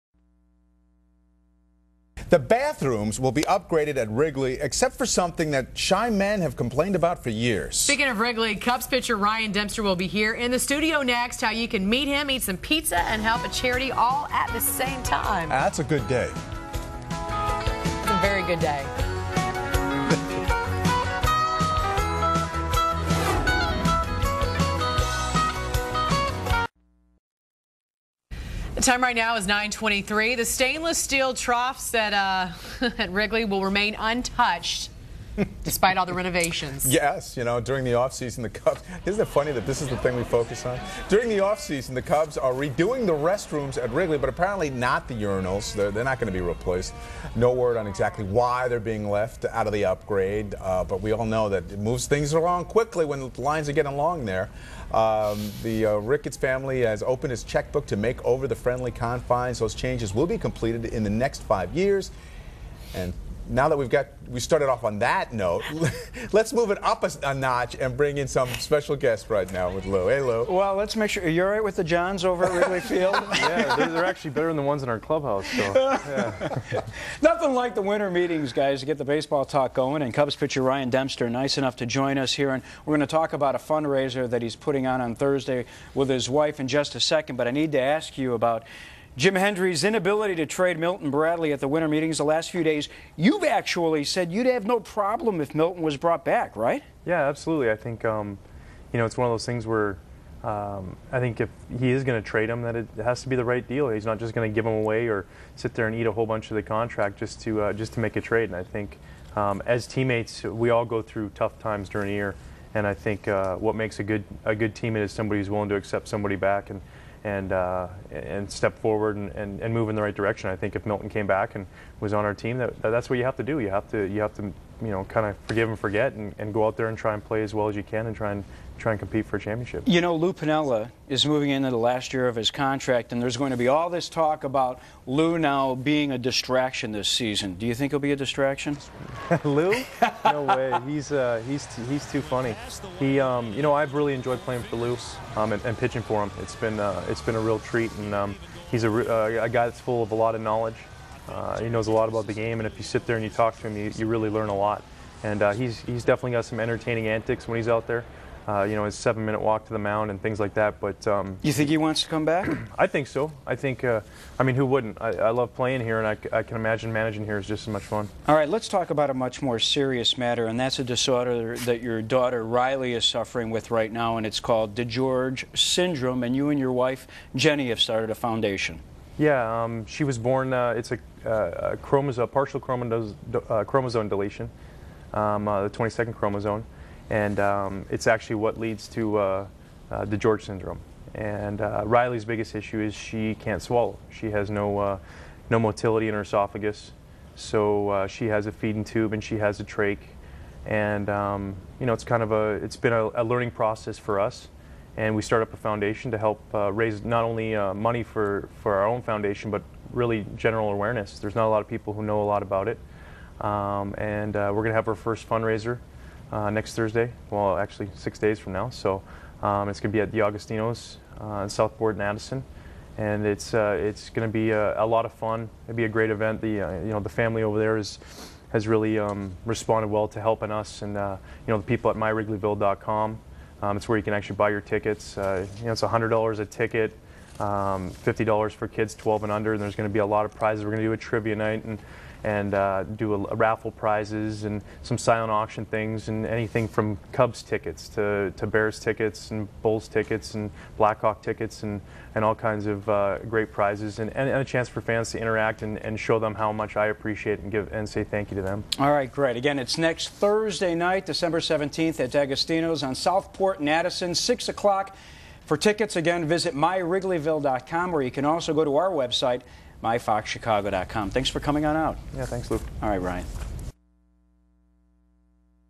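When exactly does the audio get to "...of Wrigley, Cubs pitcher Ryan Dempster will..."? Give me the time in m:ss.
0:08.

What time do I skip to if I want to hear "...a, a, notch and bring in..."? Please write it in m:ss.
1:07.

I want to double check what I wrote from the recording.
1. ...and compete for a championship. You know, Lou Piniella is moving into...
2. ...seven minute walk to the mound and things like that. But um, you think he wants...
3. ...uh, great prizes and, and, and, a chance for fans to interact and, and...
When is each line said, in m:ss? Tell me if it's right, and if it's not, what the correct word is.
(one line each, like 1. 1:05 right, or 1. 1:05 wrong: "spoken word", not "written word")
1. 2:08 right
2. 2:38 right
3. 4:12 right.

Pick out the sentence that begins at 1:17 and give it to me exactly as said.
Nothing like the winter meetings, guys, to get the baseball talk going.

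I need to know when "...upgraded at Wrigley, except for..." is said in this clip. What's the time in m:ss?
0:03.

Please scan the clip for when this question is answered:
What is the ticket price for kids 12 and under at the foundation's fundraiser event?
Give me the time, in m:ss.
3:58.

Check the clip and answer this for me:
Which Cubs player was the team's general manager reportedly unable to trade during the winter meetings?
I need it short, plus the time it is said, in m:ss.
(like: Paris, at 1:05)
Milton Bradley, at 1:30.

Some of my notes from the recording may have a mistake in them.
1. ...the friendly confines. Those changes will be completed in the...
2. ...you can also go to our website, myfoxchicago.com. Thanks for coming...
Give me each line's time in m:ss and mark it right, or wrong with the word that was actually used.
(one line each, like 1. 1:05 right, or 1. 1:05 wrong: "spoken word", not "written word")
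1. 0:58 right
2. 4:28 right.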